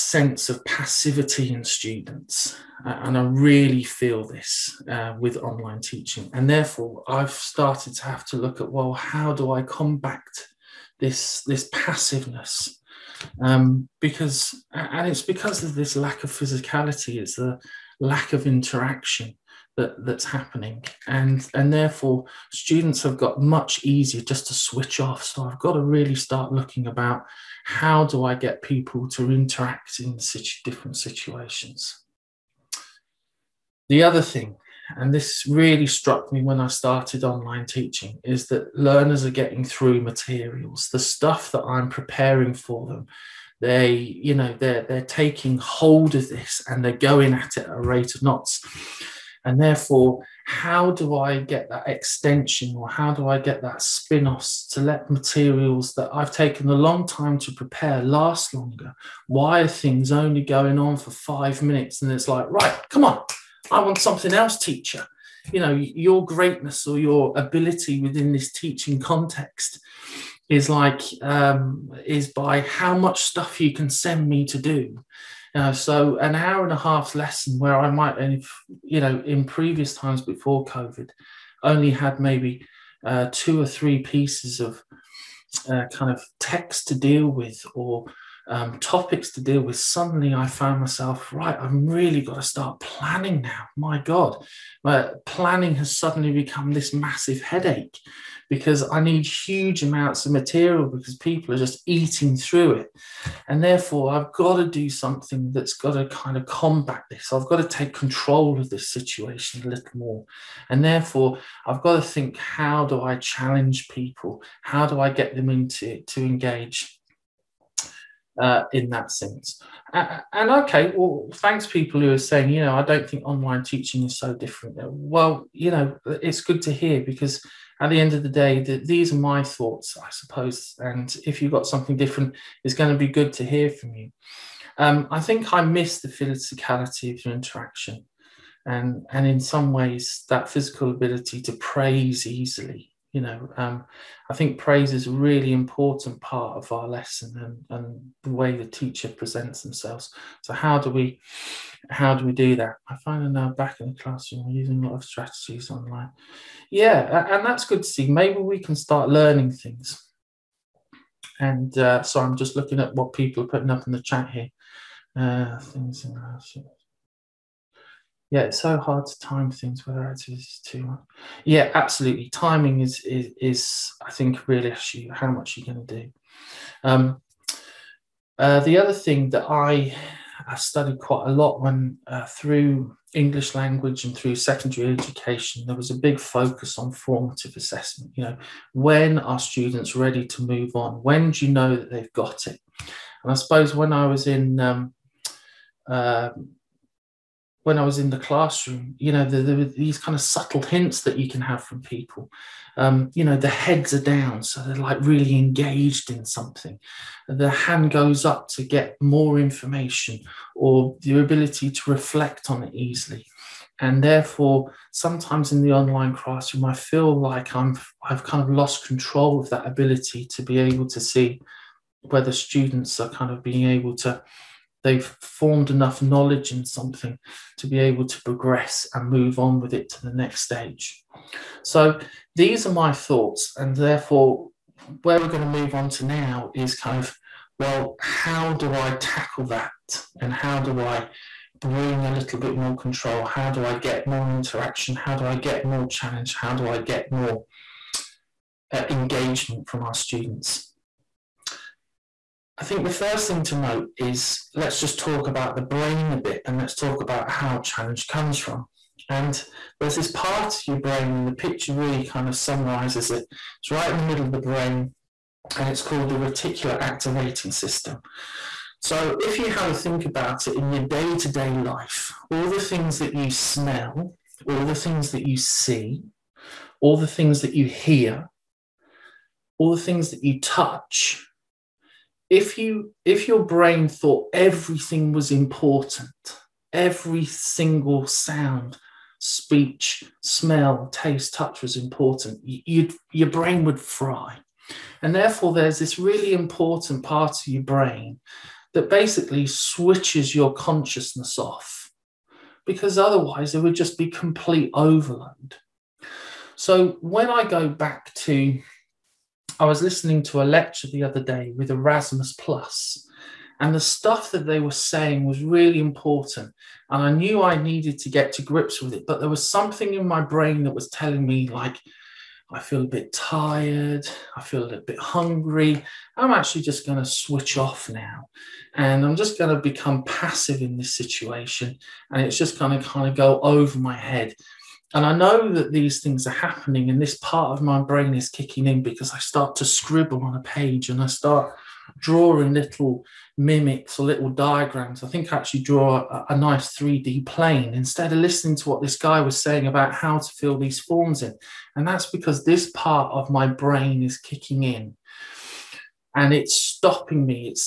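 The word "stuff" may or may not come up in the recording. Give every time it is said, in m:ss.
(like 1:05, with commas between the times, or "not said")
0:40, 1:13, 5:13.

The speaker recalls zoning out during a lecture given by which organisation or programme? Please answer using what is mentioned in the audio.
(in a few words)
Erasmus Plus.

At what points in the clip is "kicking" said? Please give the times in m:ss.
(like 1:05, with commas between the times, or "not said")
5:38, 5:54.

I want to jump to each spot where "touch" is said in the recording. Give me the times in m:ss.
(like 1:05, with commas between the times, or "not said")
4:40, 4:51.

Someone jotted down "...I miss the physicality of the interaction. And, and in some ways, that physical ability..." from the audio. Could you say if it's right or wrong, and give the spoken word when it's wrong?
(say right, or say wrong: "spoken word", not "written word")
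right.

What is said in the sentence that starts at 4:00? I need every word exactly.
And how do I bring a little bit more control?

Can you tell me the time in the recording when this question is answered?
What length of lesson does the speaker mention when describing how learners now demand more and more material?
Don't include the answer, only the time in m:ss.
1:16.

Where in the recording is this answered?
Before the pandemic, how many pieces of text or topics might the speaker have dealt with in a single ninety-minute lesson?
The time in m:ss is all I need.
1:23.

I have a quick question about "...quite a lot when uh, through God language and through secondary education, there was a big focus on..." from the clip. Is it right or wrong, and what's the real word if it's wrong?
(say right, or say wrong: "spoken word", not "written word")
wrong: "English", not "God".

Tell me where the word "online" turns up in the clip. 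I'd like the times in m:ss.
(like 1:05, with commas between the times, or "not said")
0:05, 0:37, 2:03, 2:35, 3:35.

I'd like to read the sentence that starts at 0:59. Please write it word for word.
Why are things only going on for five minutes?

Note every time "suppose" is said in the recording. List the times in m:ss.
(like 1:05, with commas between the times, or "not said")
2:10, 3:13.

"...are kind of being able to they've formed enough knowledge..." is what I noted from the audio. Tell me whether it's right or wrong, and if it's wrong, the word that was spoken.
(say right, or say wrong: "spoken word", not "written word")
right.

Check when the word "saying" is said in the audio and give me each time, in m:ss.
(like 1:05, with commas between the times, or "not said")
2:02, 5:14, 5:49.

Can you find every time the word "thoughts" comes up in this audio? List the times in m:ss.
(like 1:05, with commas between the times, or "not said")
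2:09, 3:52, 4:43.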